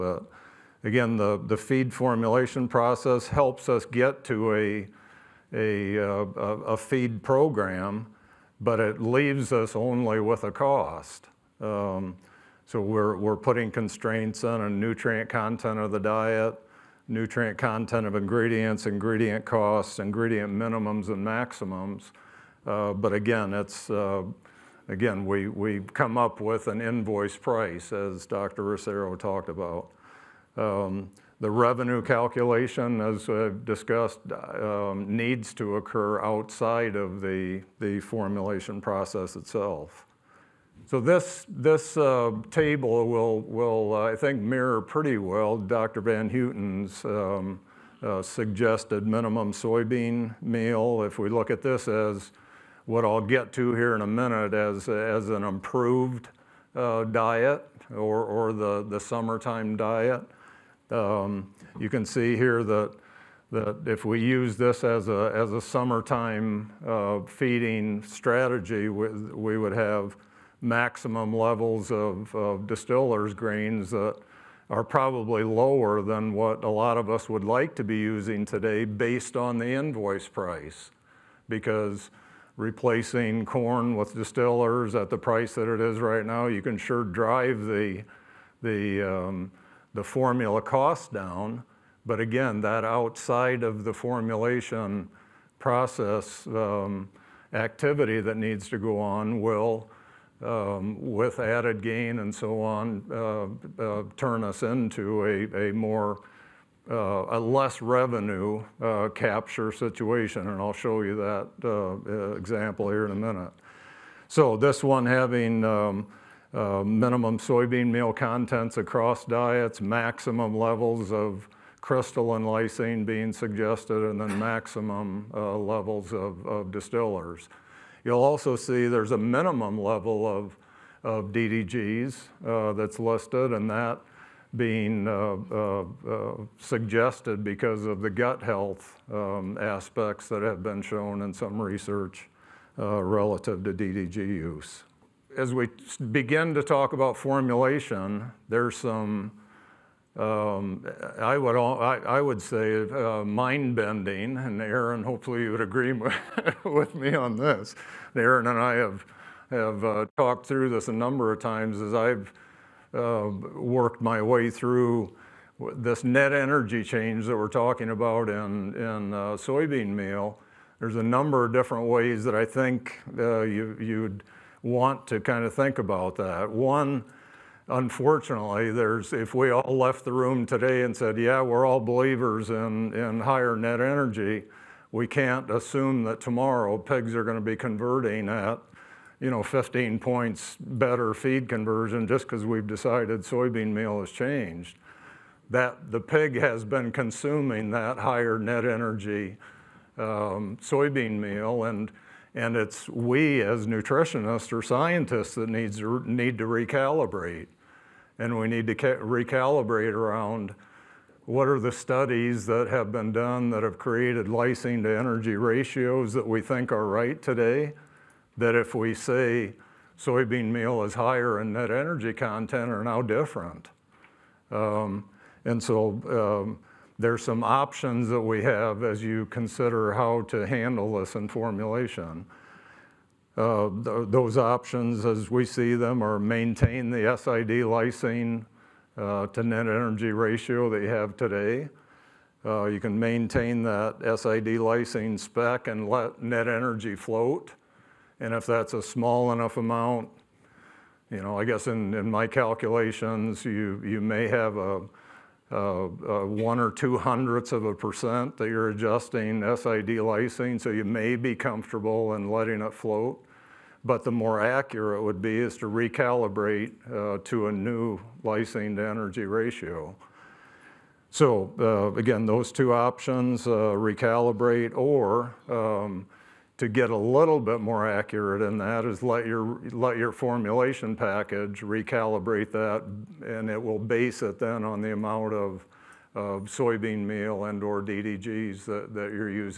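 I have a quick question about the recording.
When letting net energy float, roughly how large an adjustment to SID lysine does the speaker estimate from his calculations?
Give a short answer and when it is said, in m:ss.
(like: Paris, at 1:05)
one or two hundredths of a percent, at 4:16.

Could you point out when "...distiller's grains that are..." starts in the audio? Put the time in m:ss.
1:12.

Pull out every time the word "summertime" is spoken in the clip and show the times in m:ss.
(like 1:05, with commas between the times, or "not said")
0:59, 1:05.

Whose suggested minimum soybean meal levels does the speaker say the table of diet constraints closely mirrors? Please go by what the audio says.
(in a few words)
Dr. Van Houten.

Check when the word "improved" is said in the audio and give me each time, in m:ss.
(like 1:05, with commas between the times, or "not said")
0:55.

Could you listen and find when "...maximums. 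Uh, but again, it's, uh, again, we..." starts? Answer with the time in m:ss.
0:21.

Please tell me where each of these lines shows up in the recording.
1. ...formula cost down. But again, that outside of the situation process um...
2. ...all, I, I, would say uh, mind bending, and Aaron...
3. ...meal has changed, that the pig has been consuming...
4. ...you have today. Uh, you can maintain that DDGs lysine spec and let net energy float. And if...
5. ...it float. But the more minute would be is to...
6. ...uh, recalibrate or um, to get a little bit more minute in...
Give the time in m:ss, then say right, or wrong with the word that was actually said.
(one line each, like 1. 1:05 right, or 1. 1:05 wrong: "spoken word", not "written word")
1. 1:30 wrong: "formulation", not "situation"
2. 2:31 right
3. 3:13 right
4. 4:00 wrong: "SID", not "DDGs"
5. 4:22 wrong: "accurate", not "minute"
6. 4:33 wrong: "accurate", not "minute".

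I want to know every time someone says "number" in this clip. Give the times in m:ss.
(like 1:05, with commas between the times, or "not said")
2:40, 2:51.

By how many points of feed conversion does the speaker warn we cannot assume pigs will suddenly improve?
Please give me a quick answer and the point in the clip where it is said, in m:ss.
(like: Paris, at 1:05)
15, at 3:09.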